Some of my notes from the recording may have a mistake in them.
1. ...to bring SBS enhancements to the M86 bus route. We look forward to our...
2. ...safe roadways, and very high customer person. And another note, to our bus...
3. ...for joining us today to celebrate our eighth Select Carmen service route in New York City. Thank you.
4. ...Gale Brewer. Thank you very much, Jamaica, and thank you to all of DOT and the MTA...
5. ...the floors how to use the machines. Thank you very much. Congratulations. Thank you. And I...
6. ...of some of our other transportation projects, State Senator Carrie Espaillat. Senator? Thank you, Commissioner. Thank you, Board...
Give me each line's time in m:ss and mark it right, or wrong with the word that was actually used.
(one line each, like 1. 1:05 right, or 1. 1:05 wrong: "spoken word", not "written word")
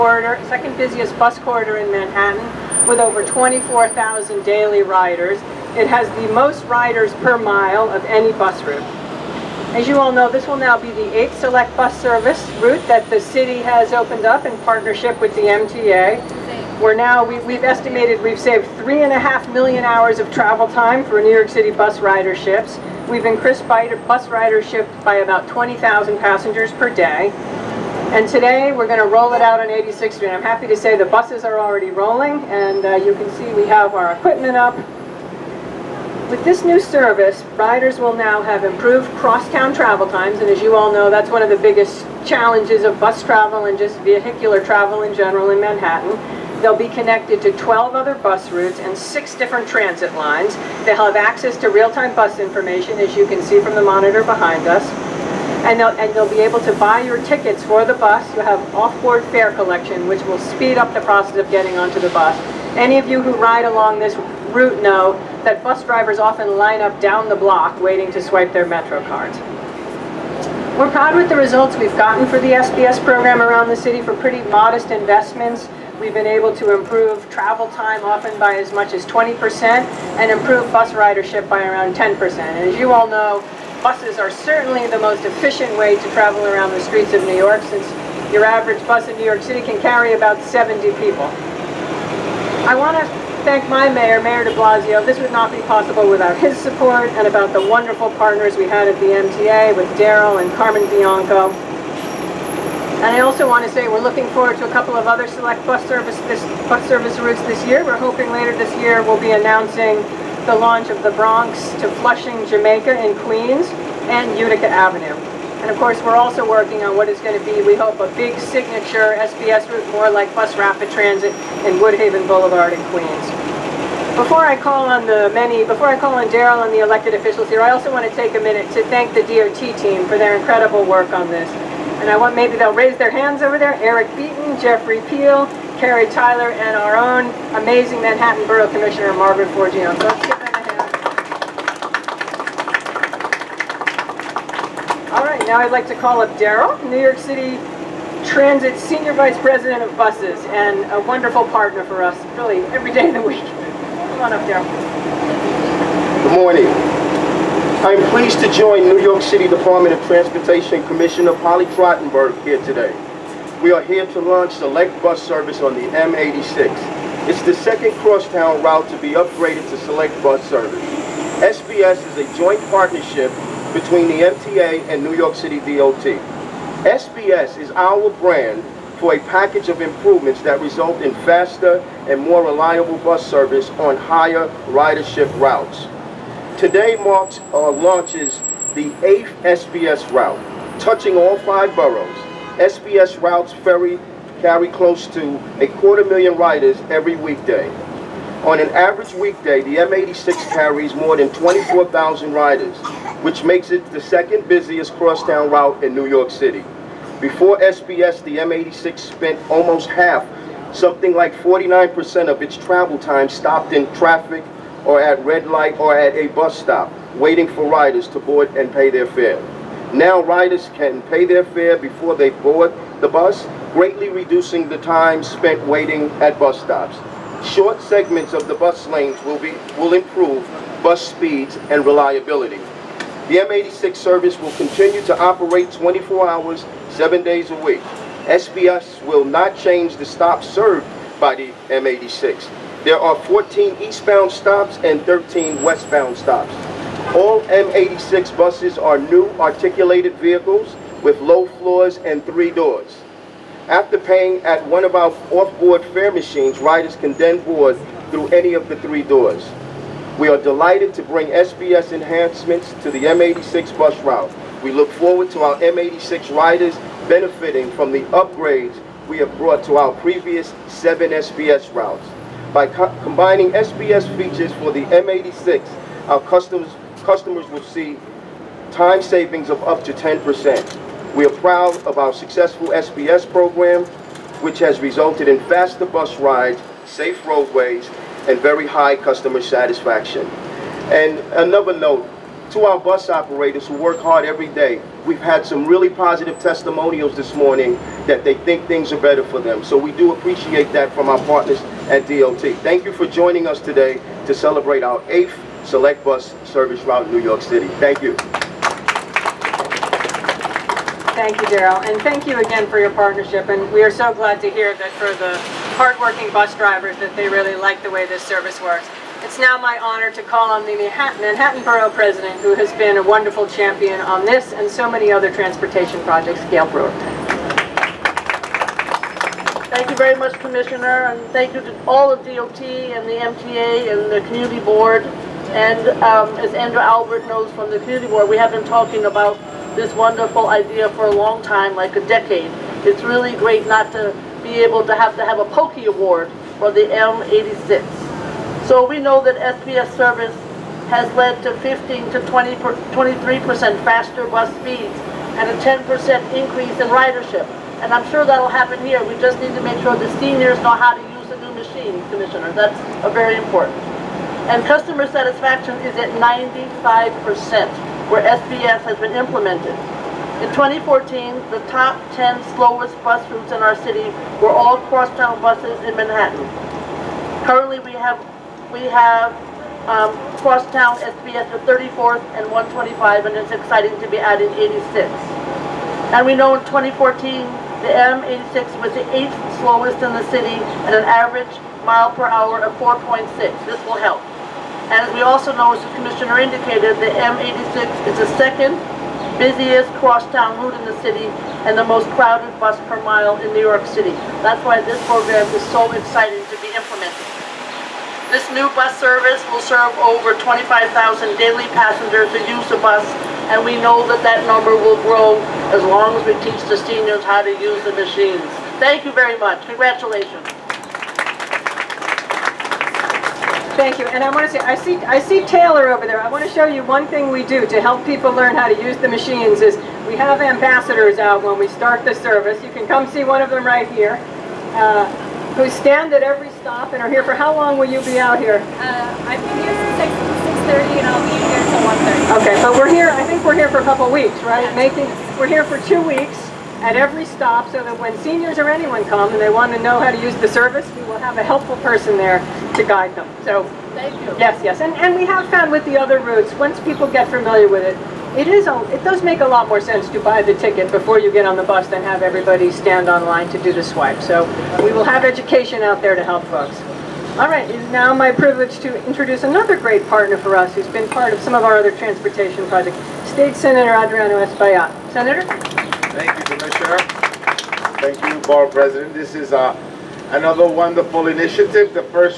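1. 4:20 right
2. 4:46 wrong: "satisfaction", not "person"
3. 5:02 wrong: "Bus", not "Carmen"
4. 5:26 wrong: "Commissioner", not "Jamaica"
5. 6:56 wrong: "seniors", not "floors"
6. 7:51 wrong: "Adriano", not "Carrie".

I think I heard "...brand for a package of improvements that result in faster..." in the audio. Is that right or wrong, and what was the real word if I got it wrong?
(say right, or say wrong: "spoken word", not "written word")
right.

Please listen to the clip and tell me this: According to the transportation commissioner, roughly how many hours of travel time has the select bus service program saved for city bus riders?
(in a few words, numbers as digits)
3.5 million hours.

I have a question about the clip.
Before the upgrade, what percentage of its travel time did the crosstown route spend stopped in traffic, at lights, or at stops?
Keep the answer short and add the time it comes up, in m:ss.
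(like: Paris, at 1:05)
49%, at 3:31.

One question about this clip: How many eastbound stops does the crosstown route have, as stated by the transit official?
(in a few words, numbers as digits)
14.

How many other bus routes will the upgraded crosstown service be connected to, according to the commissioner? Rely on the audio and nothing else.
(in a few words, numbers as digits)
12.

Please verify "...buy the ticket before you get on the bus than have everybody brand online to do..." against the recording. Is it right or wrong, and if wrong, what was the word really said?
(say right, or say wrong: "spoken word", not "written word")
wrong: "stand", not "brand".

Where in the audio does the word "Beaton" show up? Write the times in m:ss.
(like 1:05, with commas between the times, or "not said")
2:14.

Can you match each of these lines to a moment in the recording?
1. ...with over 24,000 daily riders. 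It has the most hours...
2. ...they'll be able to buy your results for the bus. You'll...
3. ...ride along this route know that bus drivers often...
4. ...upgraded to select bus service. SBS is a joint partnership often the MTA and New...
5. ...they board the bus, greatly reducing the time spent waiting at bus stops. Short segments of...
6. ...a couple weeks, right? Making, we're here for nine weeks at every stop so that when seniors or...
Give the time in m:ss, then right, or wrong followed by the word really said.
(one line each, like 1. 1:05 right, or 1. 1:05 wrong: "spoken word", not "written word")
1. 0:02 wrong: "riders", not "hours"
2. 0:56 wrong: "tickets", not "results"
3. 1:03 right
4. 2:49 wrong: "between", not "often"
5. 3:42 right
6. 7:23 wrong: "two", not "nine".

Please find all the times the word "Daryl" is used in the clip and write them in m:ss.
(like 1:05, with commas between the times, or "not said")
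1:39, 2:06, 2:26, 2:34, 5:11.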